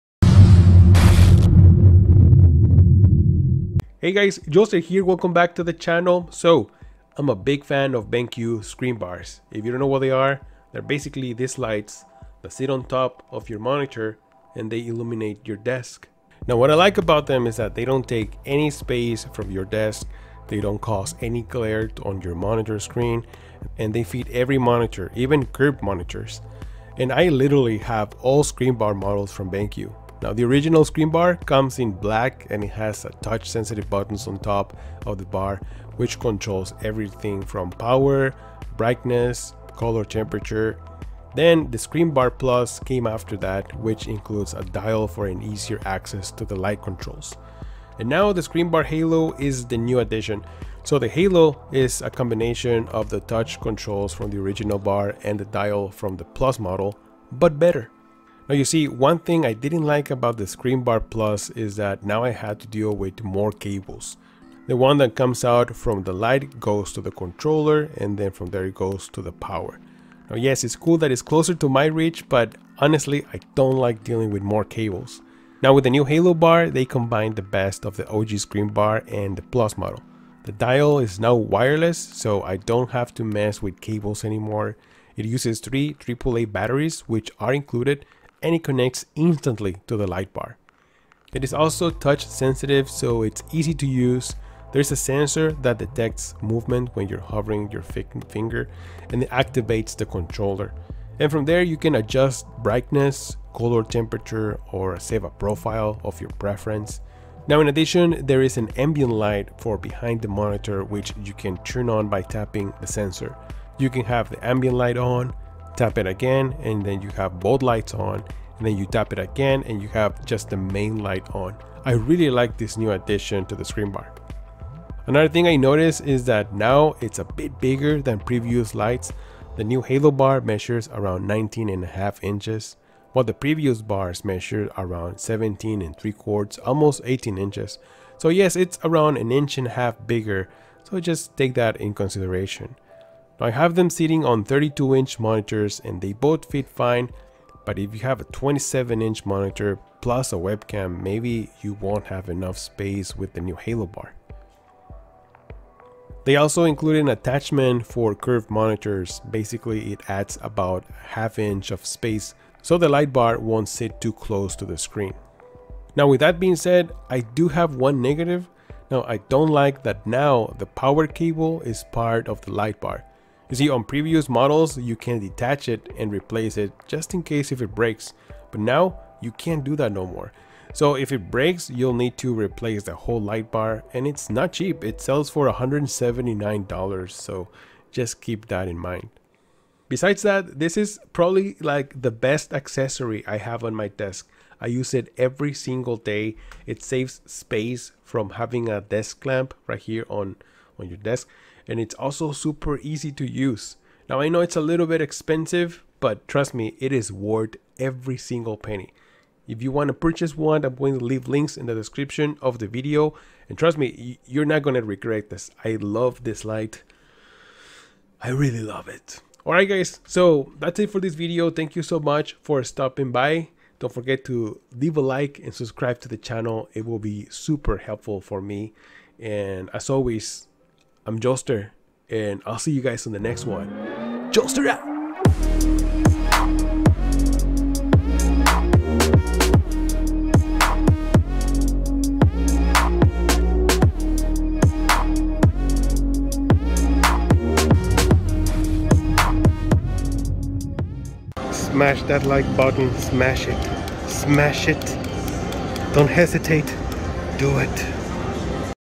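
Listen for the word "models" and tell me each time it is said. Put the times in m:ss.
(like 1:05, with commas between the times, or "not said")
0:28, 0:56, 1:19, 2:54.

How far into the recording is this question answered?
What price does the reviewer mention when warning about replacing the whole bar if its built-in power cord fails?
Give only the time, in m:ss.
3:05.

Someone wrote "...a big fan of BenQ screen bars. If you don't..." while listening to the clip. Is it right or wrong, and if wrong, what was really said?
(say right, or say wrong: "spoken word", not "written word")
right.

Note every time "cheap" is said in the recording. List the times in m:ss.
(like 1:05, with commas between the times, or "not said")
3:04.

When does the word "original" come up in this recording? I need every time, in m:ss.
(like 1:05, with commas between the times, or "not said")
0:30, 0:54.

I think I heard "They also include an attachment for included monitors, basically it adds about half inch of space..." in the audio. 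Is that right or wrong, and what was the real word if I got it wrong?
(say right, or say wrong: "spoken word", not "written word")
wrong: "curved", not "included".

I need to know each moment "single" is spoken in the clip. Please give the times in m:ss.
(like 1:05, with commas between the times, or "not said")
3:15, 3:28.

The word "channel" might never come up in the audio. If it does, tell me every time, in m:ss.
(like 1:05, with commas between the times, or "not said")
0:05, 3:46.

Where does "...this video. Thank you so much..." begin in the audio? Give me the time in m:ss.
3:40.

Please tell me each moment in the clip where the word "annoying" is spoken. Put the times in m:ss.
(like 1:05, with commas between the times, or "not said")
not said.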